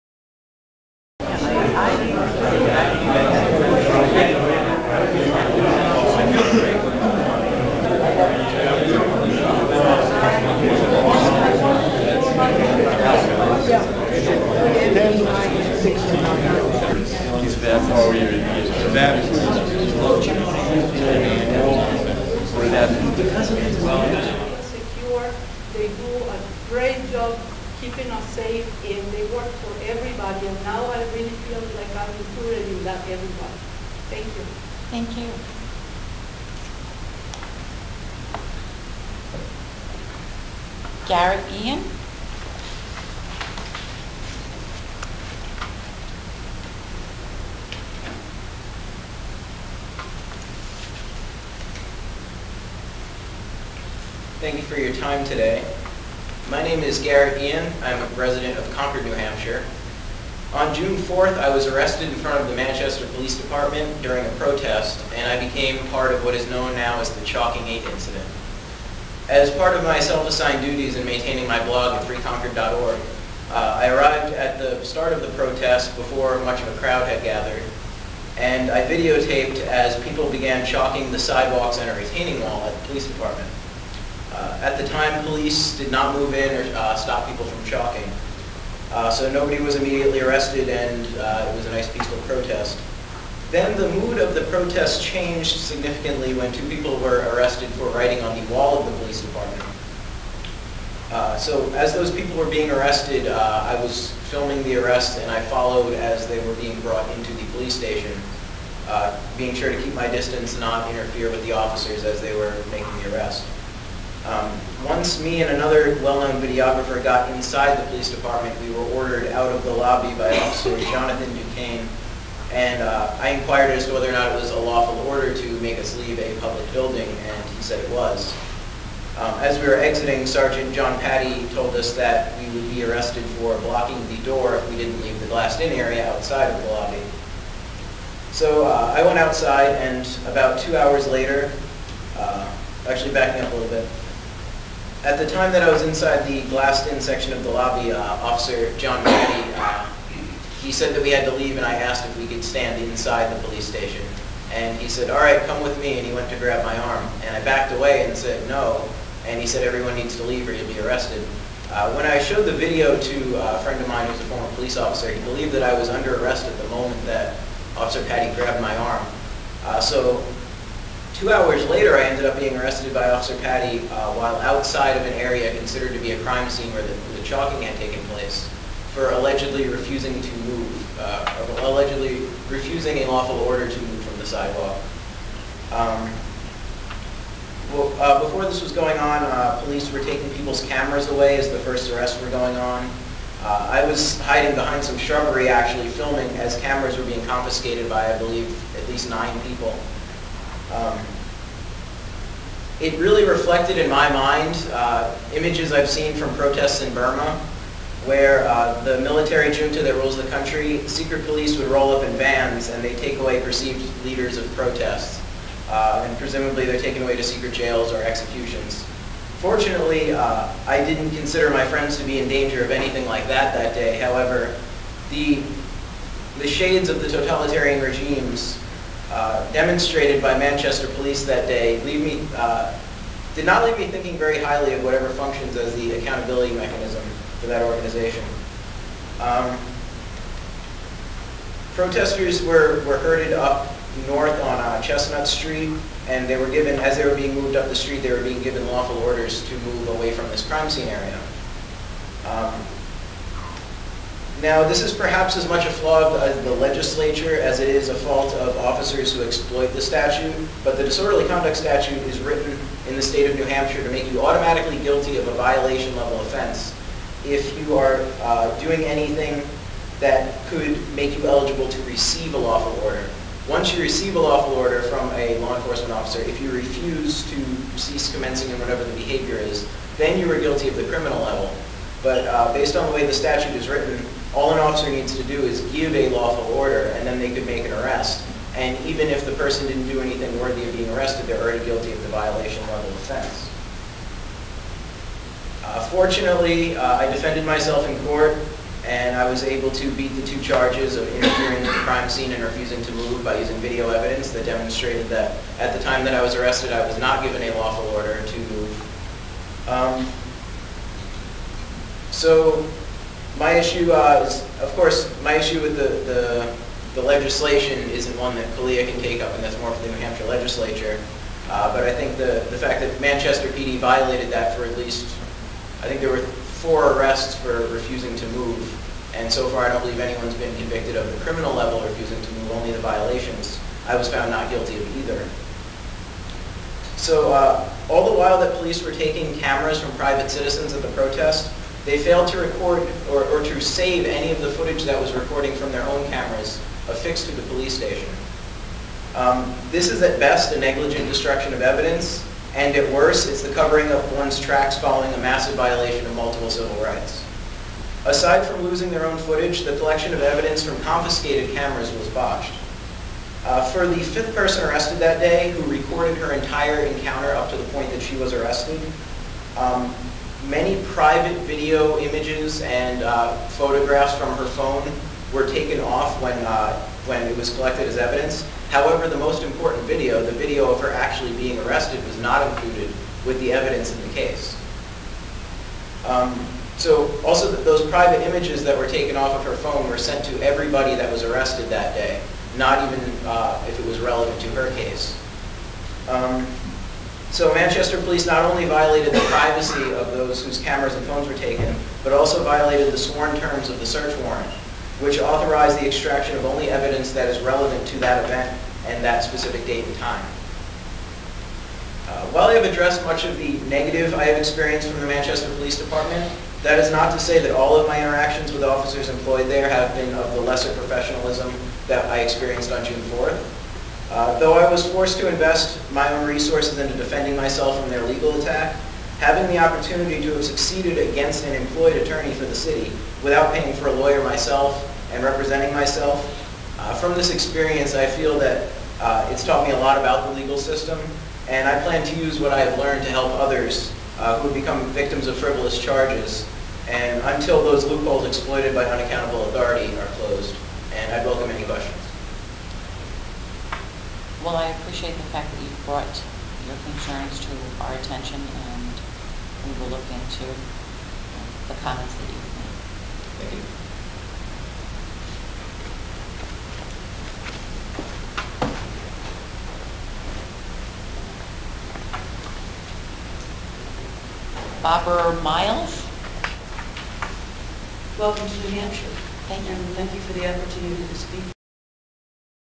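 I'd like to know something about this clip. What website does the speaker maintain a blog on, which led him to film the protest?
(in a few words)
freeconcord.org.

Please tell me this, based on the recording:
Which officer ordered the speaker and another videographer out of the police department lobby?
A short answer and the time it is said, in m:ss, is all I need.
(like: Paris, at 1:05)
Officer Jonathan Duquesne, at 2:00.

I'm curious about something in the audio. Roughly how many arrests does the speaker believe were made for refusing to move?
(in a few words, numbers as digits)
4.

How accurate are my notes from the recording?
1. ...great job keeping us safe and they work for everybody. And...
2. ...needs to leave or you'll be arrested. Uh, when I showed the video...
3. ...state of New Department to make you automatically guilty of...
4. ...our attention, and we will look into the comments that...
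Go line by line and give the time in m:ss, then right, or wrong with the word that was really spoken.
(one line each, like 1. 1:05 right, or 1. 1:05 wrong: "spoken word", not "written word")
1. 0:26 right
2. 2:39 right
3. 4:23 wrong: "Hampshire", not "Department"
4. 7:37 right.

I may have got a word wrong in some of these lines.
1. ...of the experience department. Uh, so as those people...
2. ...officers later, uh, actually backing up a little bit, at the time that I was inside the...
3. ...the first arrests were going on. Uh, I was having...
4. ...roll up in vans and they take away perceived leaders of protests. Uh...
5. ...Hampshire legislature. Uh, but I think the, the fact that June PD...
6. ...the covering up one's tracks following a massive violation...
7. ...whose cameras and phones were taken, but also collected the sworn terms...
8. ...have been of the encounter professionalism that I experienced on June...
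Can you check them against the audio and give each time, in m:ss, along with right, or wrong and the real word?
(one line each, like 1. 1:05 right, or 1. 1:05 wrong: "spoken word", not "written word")
1. 1:38 wrong: "police", not "experience"
2. 2:20 wrong: "hours", not "officers"
3. 3:11 wrong: "hiding", not "having"
4. 3:31 right
5. 5:19 wrong: "Manchester", not "June"
6. 5:53 right
7. 6:40 wrong: "violated", not "collected"
8. 6:59 wrong: "lesser", not "encounter".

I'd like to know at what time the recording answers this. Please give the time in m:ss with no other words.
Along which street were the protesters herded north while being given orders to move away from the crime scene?
4:04.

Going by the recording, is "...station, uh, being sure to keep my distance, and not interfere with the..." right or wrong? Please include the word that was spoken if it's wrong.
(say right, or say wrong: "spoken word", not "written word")
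right.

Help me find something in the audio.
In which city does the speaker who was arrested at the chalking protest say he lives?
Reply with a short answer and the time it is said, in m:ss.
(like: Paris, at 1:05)
Concord, New Hampshire, at 0:58.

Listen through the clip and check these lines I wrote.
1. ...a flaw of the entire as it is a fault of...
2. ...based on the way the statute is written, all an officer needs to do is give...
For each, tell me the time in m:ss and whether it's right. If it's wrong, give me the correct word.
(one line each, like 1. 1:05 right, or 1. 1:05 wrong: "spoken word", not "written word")
1. 4:15 wrong: "legislature", not "entire"
2. 4:42 right.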